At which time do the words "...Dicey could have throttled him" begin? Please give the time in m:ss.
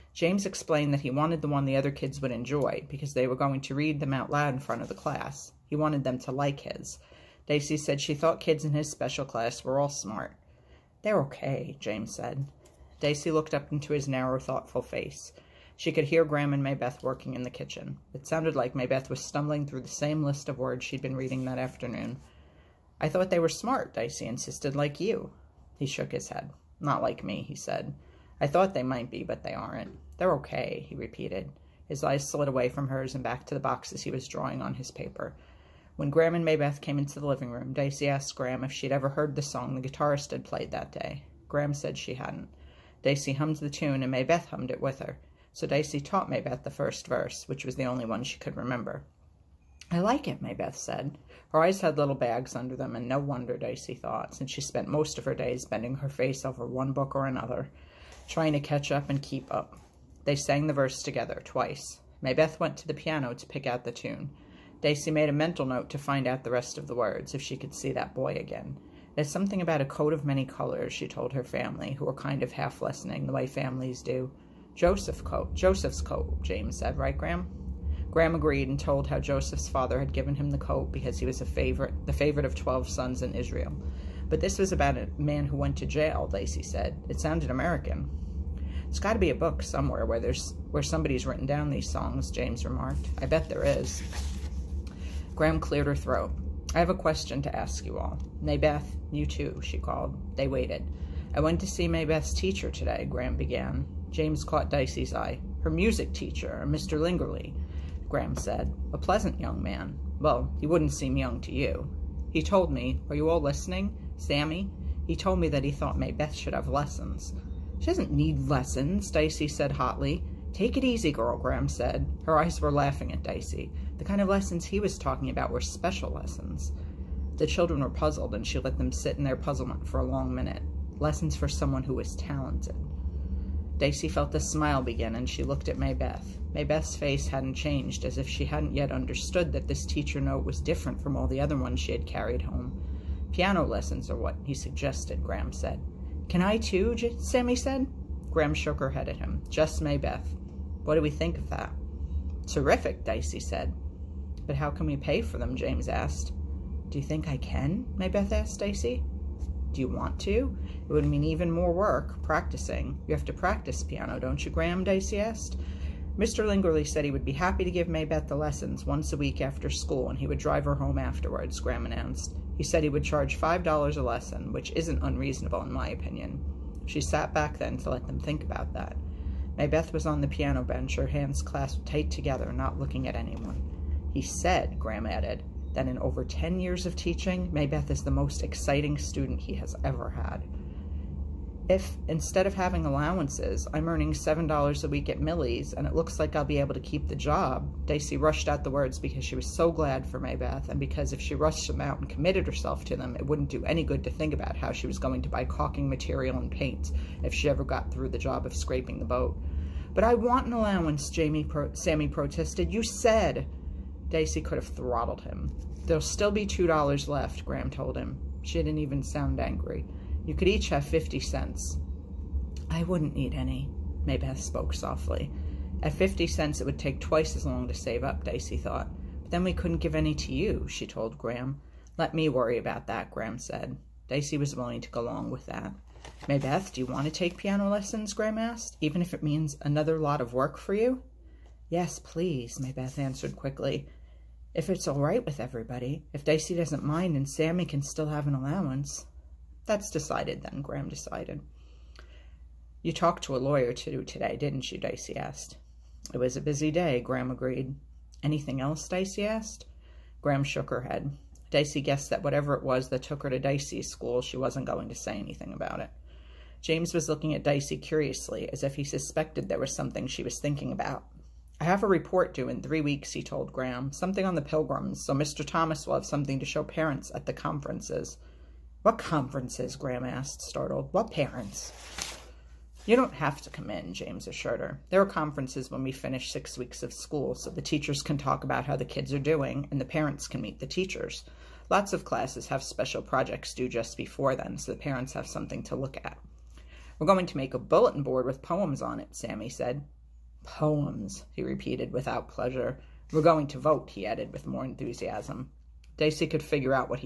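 3:34.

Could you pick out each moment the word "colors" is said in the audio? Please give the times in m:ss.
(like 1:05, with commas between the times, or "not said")
1:10.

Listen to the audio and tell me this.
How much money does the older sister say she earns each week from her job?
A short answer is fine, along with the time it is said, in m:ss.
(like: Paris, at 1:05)
$7, at 3:14.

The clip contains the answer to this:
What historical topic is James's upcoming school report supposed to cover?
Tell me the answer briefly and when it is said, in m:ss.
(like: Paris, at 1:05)
The pilgrims, at 4:34.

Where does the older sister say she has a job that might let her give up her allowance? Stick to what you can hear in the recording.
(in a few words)
Millie's.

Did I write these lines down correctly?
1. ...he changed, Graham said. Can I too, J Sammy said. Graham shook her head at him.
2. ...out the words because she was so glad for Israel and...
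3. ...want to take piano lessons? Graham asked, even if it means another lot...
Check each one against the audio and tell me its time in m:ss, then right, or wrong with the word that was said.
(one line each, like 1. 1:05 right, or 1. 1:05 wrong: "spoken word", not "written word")
1. 2:24 wrong: "suggested", not "changed"
2. 3:18 wrong: "Maybeth", not "Israel"
3. 3:56 right.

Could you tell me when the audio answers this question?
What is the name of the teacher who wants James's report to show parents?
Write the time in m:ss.
4:35.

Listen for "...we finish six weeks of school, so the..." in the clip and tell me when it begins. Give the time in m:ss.
4:45.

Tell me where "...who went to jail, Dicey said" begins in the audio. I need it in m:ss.
1:25.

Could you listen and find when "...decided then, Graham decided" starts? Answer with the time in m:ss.
4:09.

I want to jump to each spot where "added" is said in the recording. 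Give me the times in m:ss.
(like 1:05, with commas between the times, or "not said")
3:05, 5:04.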